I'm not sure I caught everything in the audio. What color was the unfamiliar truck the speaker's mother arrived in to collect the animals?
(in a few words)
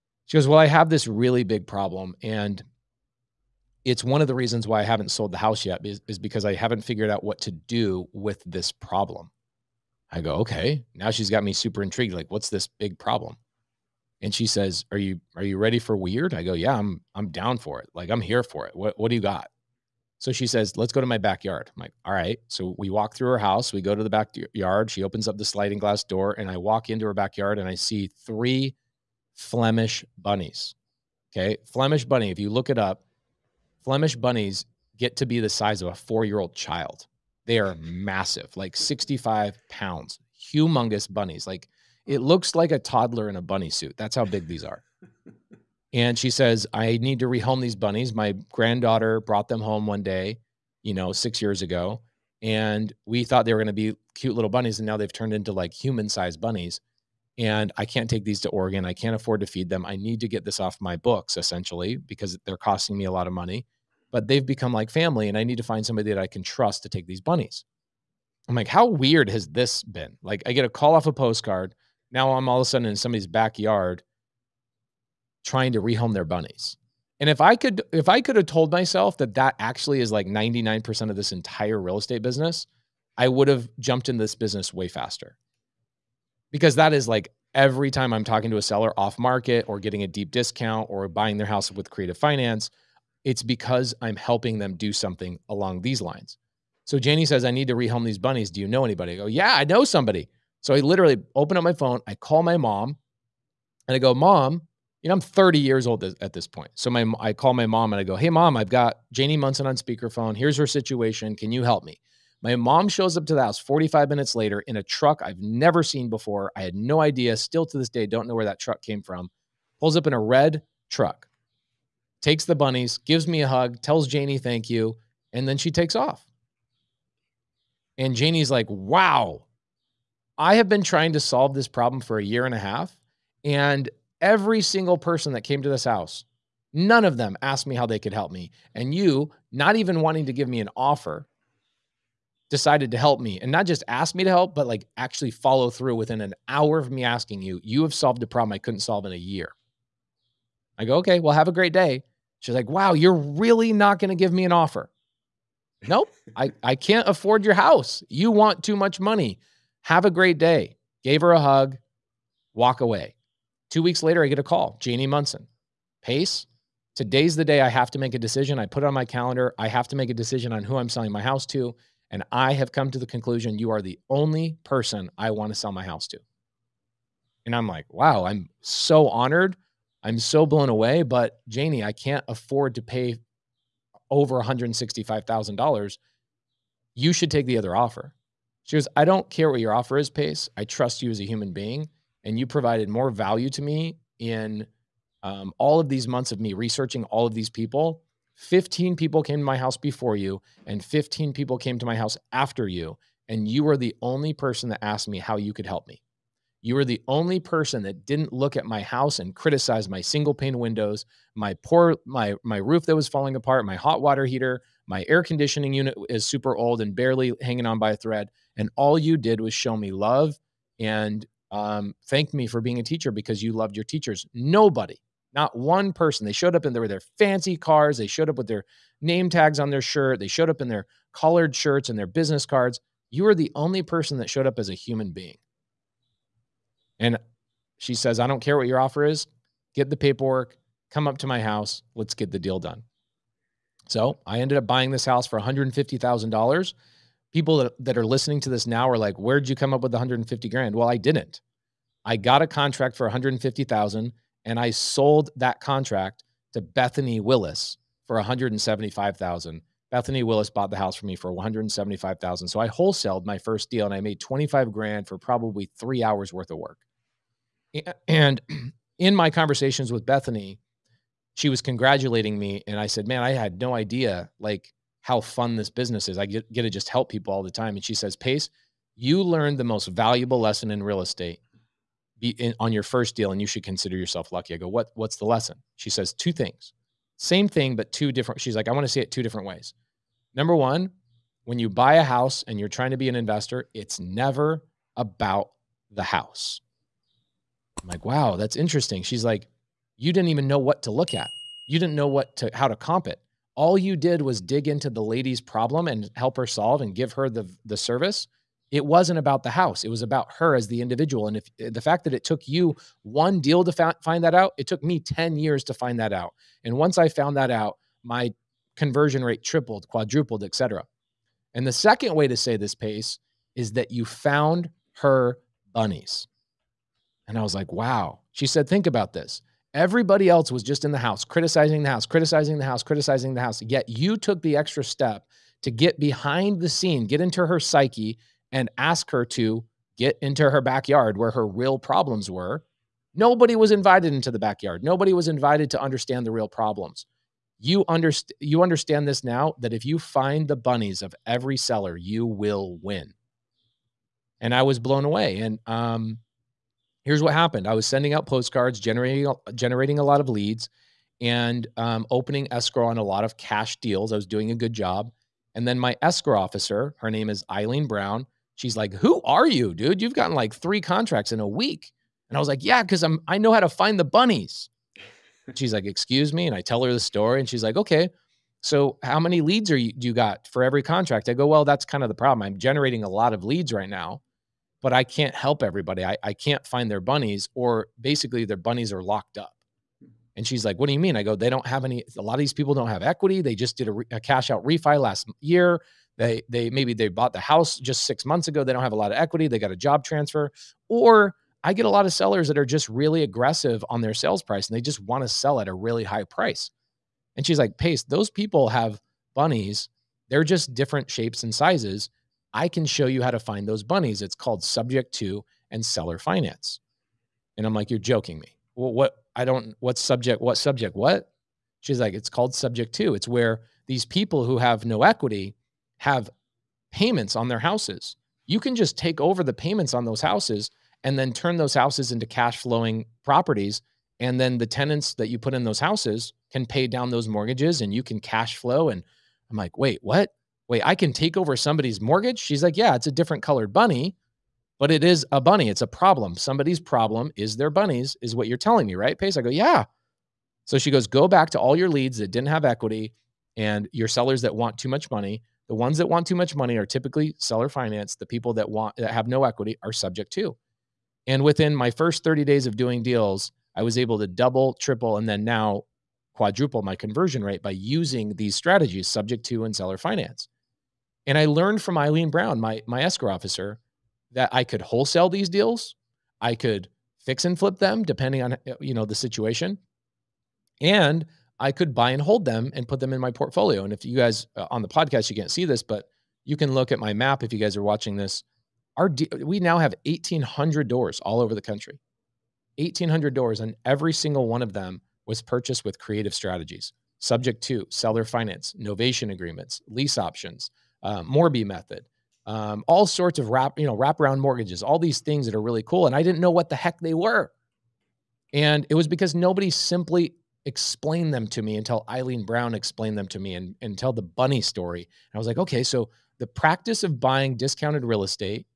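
Red.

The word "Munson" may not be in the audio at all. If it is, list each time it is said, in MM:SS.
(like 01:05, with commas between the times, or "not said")
01:49, 02:45.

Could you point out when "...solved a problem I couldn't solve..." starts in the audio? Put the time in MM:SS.
02:27.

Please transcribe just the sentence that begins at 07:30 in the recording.
So she goes, go back to all your leads that didn't have equity and your sellers that want too much money.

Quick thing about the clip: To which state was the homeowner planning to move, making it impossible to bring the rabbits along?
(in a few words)
Oregon.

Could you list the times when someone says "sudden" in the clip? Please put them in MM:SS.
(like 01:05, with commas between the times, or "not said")
01:12.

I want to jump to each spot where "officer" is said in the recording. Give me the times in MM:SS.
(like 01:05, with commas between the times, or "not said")
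06:06, 07:53.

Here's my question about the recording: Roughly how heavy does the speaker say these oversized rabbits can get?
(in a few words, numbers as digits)
65 pounds.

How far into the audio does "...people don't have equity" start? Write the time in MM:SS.
06:32.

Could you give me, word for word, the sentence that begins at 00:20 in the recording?
So she says, Let's go to my backyard.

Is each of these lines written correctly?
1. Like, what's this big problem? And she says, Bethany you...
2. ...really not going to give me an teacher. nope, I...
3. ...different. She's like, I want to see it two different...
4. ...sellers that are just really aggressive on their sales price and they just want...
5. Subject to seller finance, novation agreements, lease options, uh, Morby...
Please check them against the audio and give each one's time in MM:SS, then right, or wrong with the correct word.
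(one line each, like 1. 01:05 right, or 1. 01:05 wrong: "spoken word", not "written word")
1. 00:12 wrong: "Are", not "Bethany"
2. 02:33 wrong: "offer", not "teacher"
3. 04:48 right
4. 06:42 right
5. 08:17 right.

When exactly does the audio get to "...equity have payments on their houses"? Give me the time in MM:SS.
07:05.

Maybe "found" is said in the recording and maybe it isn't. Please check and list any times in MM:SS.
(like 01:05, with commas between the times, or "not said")
05:17, 05:24.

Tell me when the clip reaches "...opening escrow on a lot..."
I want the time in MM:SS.
06:02.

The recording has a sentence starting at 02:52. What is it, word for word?
And I have come to the conclusion you are the only person I want to sell my house to.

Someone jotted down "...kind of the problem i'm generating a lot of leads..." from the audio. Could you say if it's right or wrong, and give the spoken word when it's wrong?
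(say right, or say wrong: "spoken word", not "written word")
right.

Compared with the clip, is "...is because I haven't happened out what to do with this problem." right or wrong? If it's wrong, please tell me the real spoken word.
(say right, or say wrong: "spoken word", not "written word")
wrong: "figured", not "happened".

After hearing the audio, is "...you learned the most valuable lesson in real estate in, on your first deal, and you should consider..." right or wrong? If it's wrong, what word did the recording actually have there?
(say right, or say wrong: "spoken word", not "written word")
right.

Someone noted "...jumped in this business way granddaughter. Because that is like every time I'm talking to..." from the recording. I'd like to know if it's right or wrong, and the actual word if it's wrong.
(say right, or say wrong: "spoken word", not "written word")
wrong: "faster", not "granddaughter".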